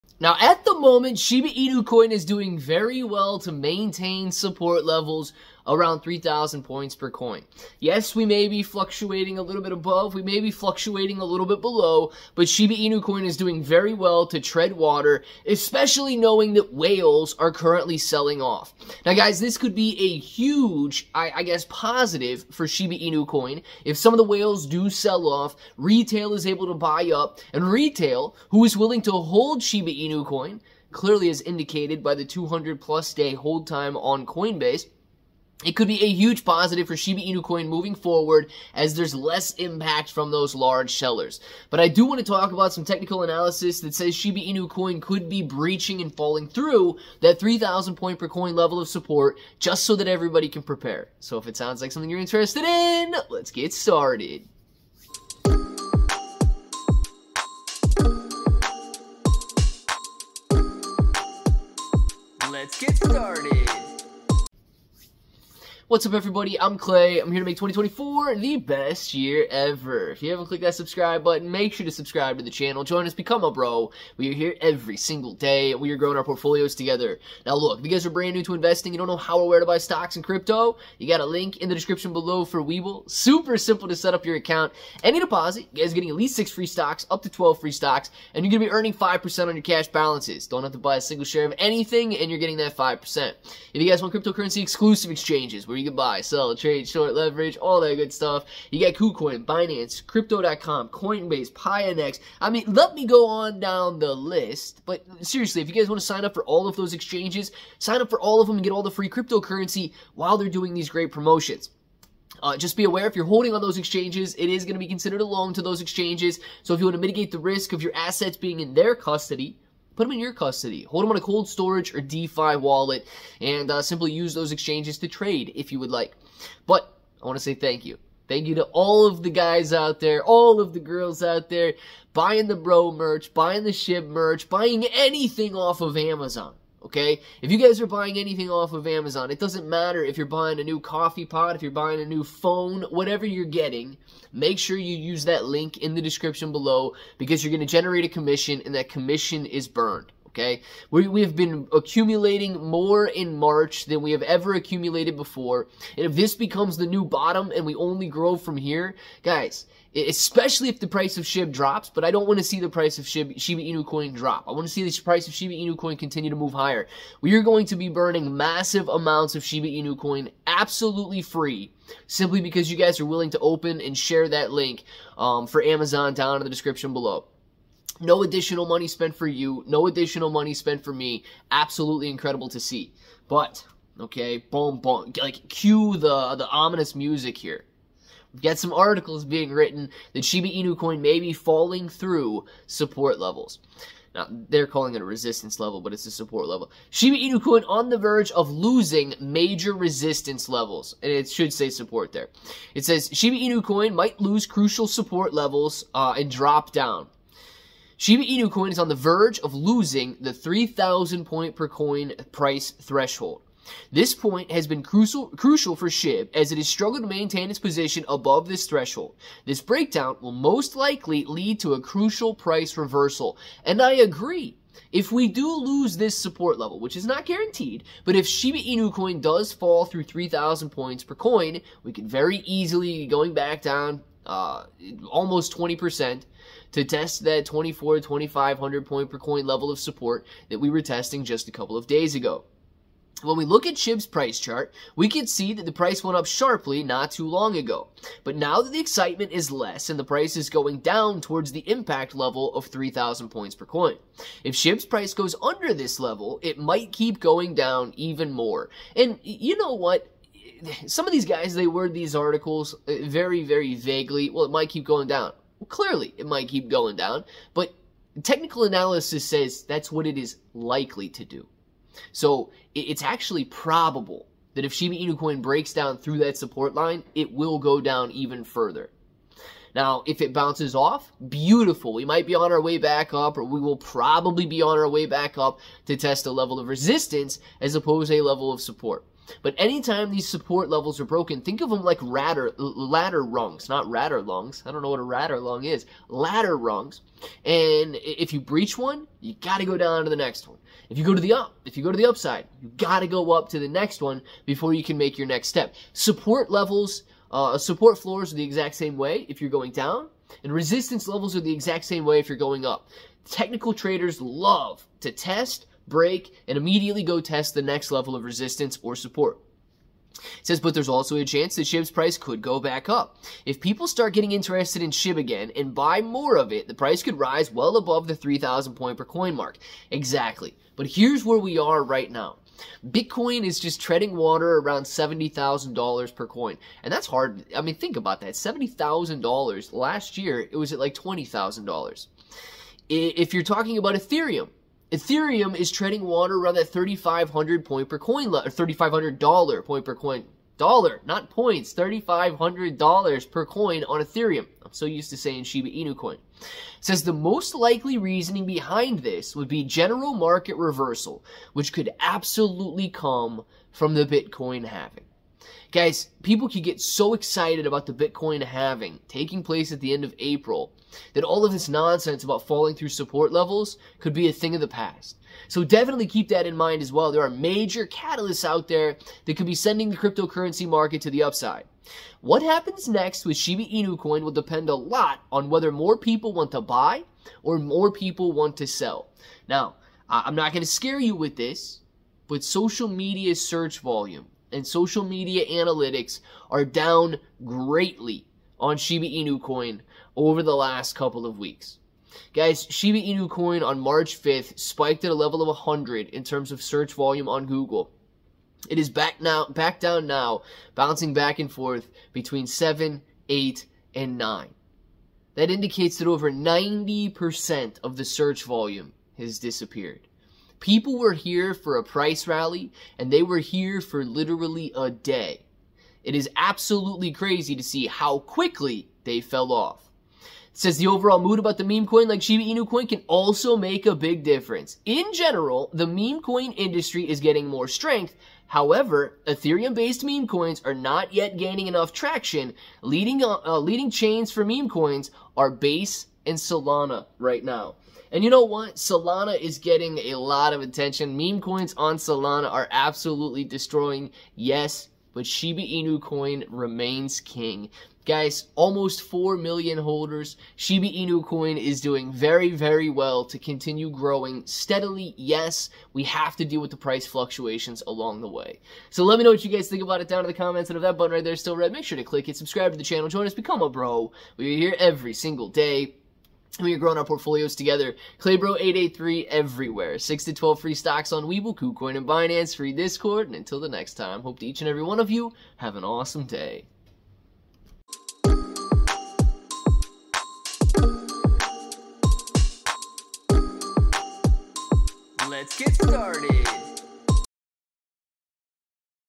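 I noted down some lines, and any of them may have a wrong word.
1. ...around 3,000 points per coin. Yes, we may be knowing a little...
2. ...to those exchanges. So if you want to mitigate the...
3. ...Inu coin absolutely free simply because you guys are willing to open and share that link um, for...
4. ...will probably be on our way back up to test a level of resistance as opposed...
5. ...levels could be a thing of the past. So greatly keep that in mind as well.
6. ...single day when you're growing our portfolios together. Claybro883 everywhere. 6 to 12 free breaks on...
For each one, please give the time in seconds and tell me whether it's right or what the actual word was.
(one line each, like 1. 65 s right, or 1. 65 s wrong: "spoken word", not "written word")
1. 5 s wrong: "fluctuating", not "knowing"
2. 115 s right
3. 169 s right
4. 283 s right
5. 373 s wrong: "definitely", not "greatly"
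6. 475 s wrong: "stocks", not "breaks".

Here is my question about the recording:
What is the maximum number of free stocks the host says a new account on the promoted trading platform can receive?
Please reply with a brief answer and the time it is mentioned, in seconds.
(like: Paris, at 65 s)
12, at 87 s.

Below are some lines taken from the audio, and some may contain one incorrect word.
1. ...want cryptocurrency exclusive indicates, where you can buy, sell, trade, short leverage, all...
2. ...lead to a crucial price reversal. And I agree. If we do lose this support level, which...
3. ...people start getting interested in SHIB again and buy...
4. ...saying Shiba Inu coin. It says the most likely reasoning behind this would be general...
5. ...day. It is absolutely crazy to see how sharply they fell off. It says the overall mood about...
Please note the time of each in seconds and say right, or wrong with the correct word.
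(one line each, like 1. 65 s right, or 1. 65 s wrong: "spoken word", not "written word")
1. 94 s wrong: "exchanges", not "indicates"
2. 221 s right
3. 323 s right
4. 355 s right
5. 424 s wrong: "quickly", not "sharply".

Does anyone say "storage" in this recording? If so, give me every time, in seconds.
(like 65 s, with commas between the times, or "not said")
121 s.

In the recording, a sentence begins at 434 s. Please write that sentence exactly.
In general, the meme coin industry is getting more strength.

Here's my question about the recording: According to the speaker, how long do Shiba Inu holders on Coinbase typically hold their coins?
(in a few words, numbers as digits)
200 plus day.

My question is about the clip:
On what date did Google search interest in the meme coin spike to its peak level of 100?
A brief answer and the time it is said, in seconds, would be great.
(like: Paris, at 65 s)
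March 5th, at 403 s.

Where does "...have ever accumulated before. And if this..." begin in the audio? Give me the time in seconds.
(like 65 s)
154 s.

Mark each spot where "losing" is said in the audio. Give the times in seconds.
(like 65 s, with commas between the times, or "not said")
198 s, 209 s.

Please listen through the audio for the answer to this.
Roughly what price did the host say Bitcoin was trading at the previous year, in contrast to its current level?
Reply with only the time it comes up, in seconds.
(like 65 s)
340 s.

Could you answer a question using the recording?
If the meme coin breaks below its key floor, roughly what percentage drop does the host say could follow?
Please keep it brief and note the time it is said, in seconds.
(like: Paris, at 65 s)
20%, at 235 s.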